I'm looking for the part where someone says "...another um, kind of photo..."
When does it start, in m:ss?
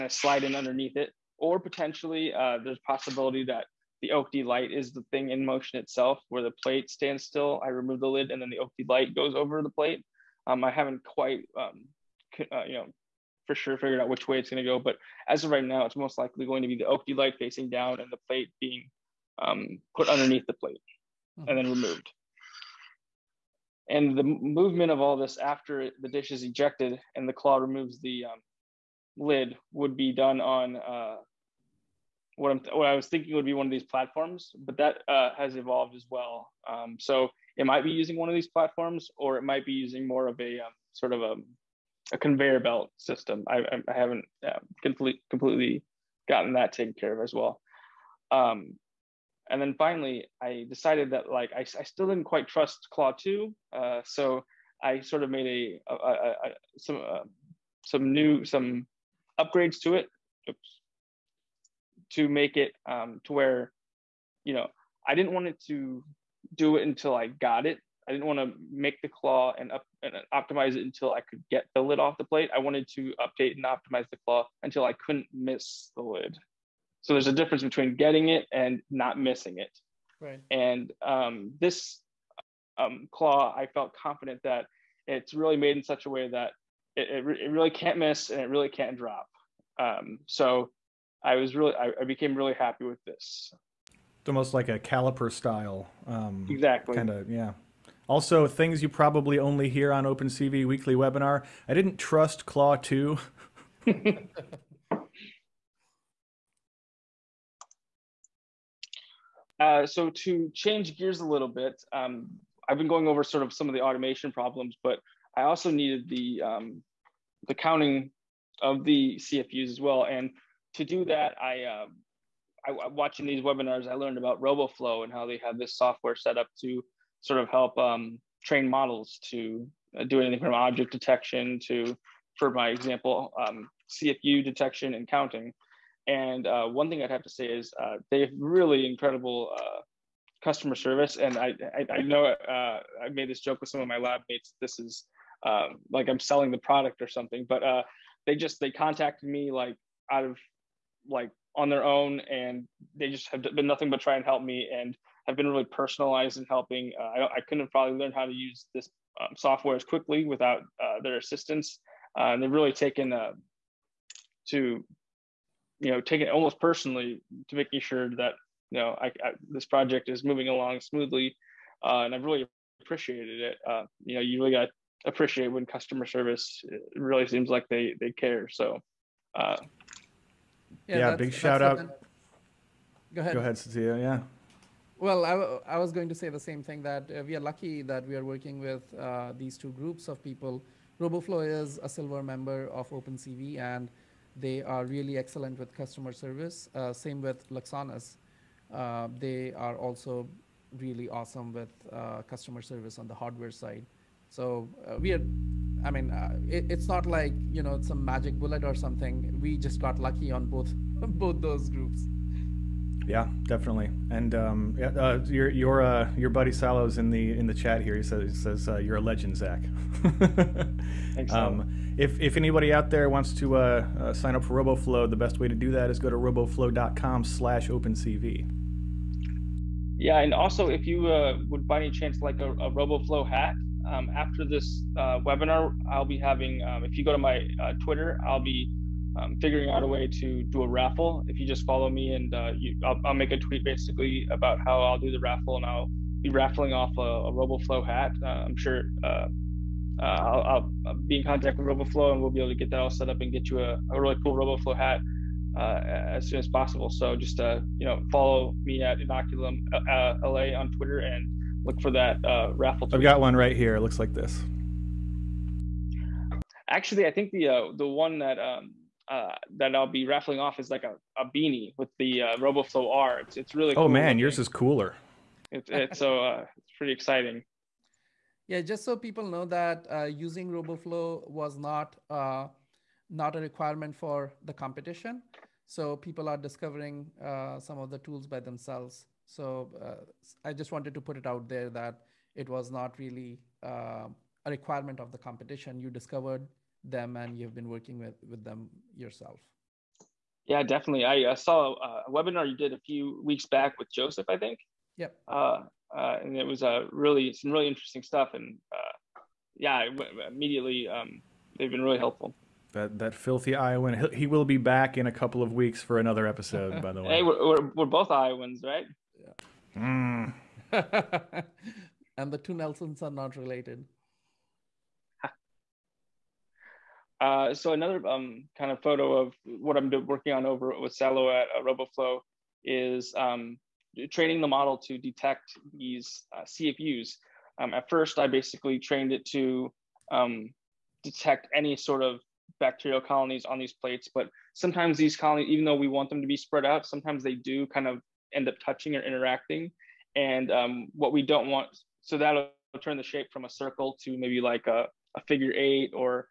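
5:27.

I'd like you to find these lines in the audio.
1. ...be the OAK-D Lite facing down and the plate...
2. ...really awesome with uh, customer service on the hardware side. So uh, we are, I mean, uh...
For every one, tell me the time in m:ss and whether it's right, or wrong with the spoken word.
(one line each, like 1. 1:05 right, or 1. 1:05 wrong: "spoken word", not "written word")
1. 0:16 right
2. 3:20 right.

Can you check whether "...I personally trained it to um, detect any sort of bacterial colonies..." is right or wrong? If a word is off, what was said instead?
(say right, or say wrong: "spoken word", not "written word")
wrong: "basically", not "personally".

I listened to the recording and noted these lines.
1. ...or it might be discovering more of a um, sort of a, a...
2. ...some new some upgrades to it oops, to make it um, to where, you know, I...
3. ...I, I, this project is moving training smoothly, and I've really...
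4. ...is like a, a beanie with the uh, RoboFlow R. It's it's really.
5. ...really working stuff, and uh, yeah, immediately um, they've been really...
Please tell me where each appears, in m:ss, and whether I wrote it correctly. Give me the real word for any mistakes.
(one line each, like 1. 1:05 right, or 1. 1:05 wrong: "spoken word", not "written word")
1. 0:39 wrong: "using", not "discovering"
2. 0:57 right
3. 2:48 wrong: "along", not "training"
4. 4:30 right
5. 5:07 wrong: "interesting", not "working".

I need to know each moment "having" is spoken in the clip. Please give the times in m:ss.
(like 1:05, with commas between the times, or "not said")
3:56.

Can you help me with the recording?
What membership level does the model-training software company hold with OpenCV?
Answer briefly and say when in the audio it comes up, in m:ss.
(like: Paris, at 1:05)
Silver, at 3:11.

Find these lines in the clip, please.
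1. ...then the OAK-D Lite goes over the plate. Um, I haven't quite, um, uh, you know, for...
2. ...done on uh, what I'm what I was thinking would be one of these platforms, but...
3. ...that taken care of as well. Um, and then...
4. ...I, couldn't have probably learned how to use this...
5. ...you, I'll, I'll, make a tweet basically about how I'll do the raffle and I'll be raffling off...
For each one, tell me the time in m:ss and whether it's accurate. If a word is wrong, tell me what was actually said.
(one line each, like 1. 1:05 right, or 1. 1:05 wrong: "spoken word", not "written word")
1. 0:08 right
2. 0:30 right
3. 0:46 right
4. 2:37 right
5. 4:02 right.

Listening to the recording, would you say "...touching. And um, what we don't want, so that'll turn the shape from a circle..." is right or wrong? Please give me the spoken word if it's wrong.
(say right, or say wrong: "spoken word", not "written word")
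wrong: "interacting", not "touching".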